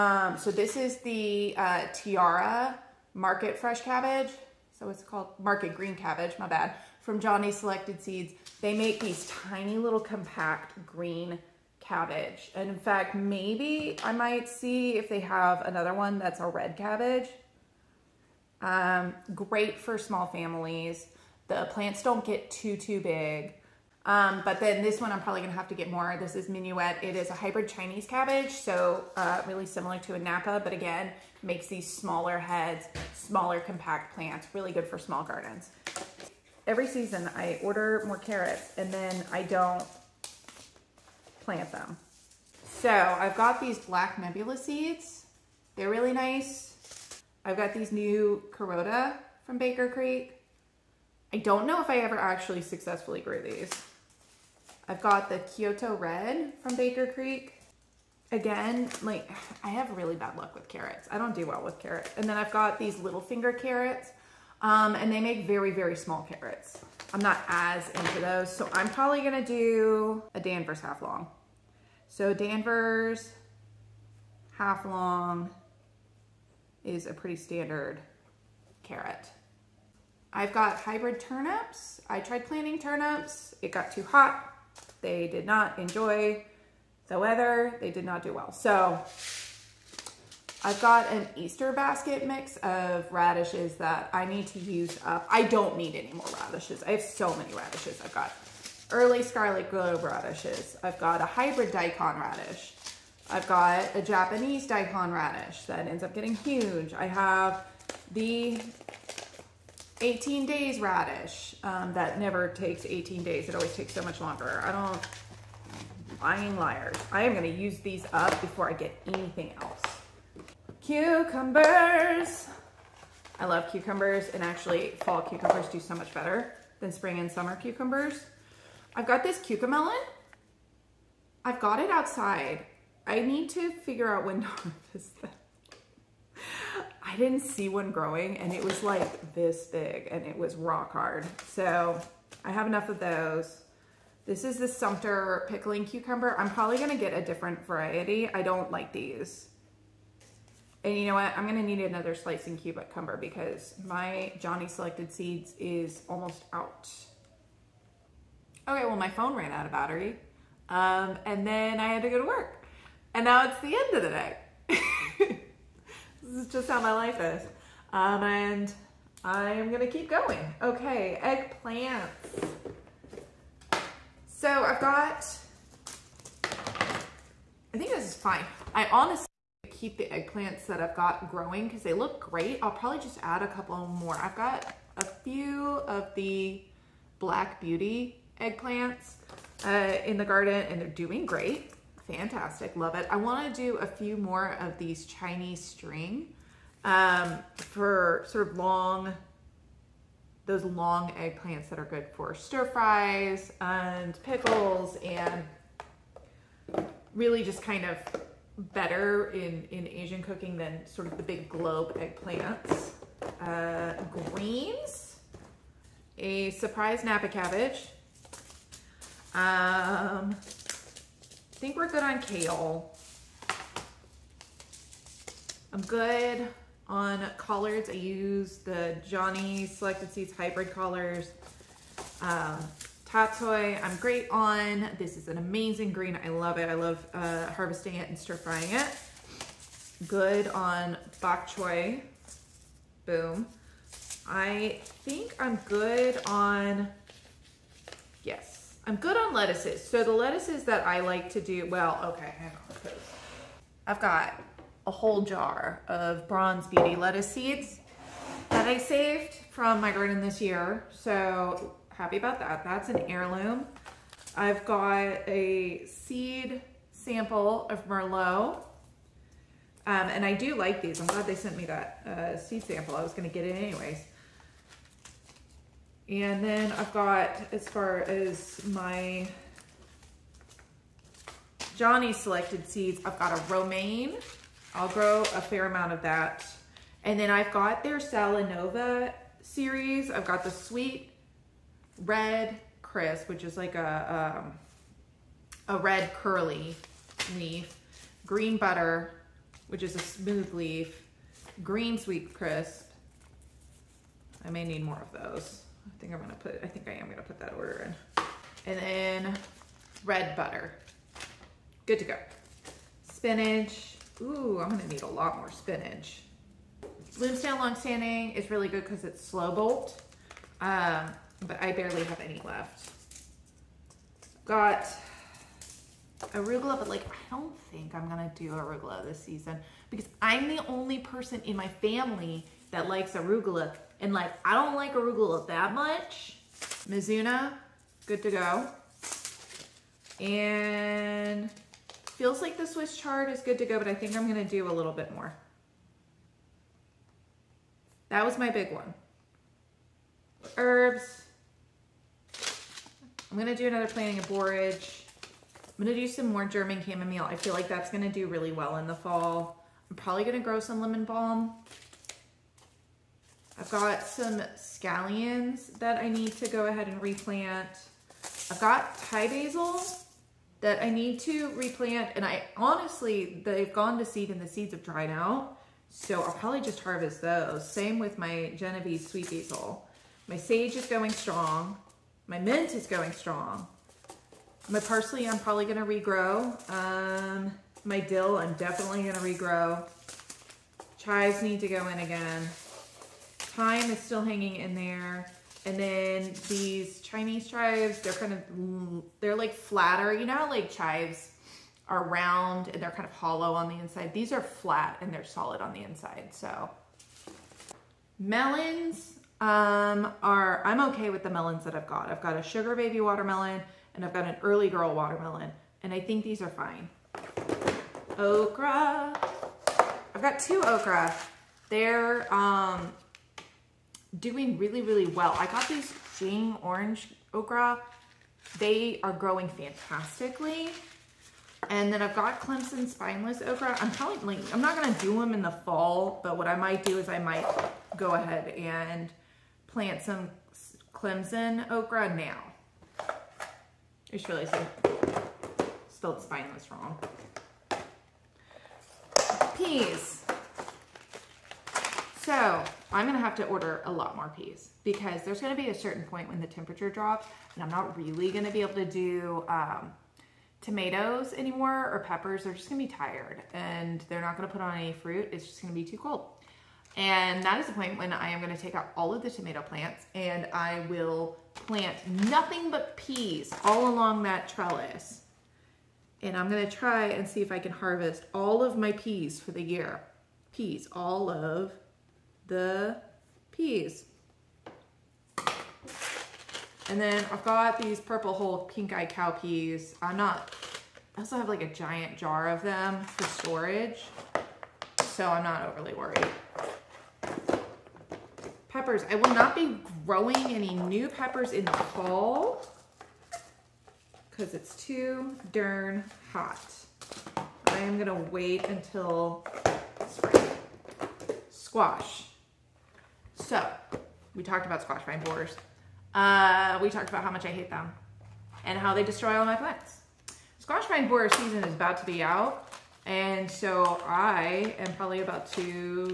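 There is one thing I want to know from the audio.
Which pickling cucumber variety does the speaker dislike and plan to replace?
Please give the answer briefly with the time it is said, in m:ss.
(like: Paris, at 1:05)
Sumter, at 2:24.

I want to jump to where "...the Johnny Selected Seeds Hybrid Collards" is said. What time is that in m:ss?
3:48.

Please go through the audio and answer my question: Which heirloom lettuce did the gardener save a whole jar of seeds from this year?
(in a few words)
Bronze beauty.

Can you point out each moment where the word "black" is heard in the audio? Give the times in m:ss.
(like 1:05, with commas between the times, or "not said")
0:43, 3:07.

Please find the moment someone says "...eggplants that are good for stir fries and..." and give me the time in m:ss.
3:21.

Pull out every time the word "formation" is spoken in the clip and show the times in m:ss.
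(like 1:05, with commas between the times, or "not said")
not said.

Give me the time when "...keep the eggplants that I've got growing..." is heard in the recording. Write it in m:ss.
2:59.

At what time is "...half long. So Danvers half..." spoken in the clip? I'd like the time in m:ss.
1:10.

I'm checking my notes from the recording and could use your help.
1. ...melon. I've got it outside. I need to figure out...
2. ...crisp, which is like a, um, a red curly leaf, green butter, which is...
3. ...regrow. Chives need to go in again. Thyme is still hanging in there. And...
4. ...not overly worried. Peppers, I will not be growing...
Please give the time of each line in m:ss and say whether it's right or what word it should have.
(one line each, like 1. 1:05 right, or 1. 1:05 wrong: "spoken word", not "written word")
1. 2:09 right
2. 4:52 right
3. 6:29 right
4. 8:15 right.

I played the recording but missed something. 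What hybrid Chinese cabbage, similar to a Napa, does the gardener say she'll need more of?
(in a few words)
Minuet.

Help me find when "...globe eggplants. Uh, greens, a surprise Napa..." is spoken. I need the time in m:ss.
3:31.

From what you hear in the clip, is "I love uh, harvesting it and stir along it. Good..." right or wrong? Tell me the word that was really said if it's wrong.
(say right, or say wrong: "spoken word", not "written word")
wrong: "frying", not "along".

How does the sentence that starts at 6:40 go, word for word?
You know how like chives are round and they're kind of hollow on the inside?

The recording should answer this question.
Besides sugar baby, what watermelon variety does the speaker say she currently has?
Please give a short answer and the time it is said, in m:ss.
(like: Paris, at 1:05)
Early girl, at 6:54.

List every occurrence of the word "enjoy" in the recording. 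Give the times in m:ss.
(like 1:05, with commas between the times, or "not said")
1:25.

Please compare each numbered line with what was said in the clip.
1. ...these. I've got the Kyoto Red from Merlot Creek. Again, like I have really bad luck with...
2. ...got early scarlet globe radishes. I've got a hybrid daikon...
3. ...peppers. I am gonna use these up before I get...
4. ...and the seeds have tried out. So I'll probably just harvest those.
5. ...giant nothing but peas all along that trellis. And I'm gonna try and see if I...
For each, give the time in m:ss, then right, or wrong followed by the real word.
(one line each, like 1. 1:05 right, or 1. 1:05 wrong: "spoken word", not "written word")
1. 0:53 wrong: "Baker", not "Merlot"
2. 1:38 right
3. 1:56 wrong: "liars", not "peppers"
4. 6:14 wrong: "dried", not "tried"
5. 7:51 wrong: "plant", not "giant".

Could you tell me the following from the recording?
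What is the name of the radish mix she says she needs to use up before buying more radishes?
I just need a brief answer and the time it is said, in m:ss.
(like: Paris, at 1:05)
Easter basket mix, at 1:31.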